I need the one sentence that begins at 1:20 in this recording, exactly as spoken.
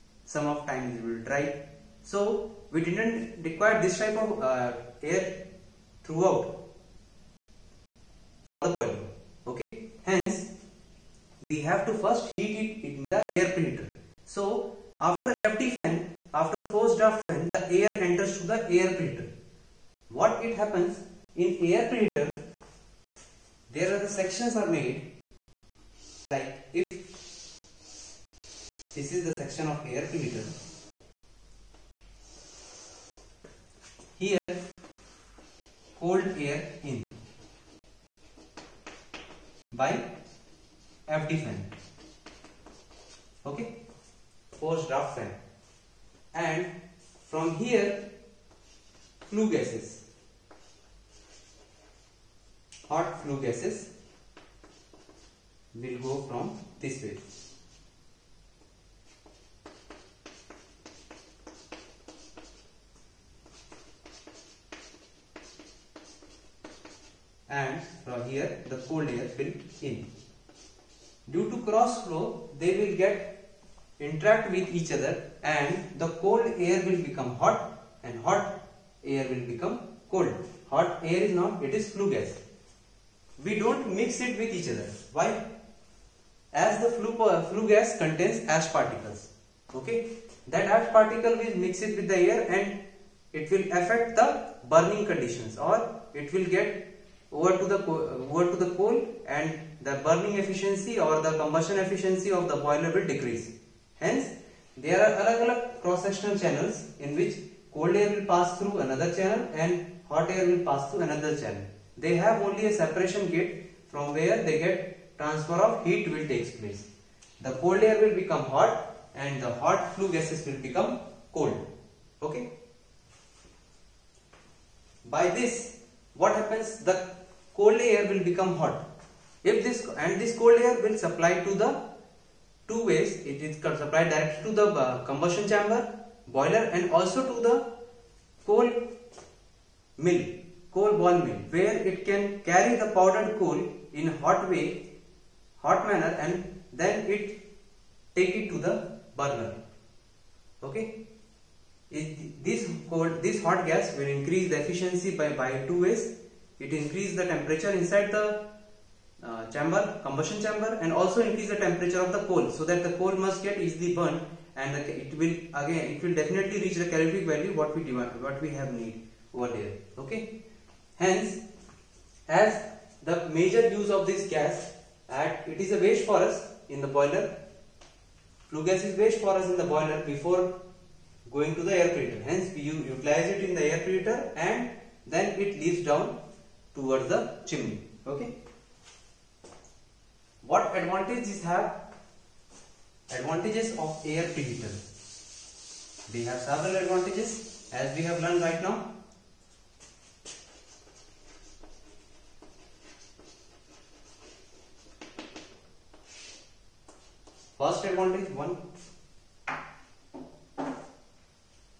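Hot air is not, it is flue gas we don't mix it with each other.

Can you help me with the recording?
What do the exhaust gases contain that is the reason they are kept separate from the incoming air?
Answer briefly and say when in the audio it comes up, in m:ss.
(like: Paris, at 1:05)
Ash particles, at 1:28.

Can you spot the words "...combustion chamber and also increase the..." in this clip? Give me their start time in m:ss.
2:40.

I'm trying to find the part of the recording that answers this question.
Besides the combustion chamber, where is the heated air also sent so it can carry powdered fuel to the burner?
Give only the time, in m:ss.
2:20.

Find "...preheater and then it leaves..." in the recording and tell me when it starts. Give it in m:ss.
3:03.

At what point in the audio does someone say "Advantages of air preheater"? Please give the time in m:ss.
3:13.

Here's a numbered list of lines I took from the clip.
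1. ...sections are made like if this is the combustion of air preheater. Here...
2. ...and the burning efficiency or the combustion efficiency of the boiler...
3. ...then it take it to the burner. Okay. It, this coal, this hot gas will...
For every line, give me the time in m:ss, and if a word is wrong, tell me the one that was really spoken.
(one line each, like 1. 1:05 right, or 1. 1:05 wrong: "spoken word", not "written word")
1. 0:24 wrong: "section", not "combustion"
2. 1:39 right
3. 2:26 right.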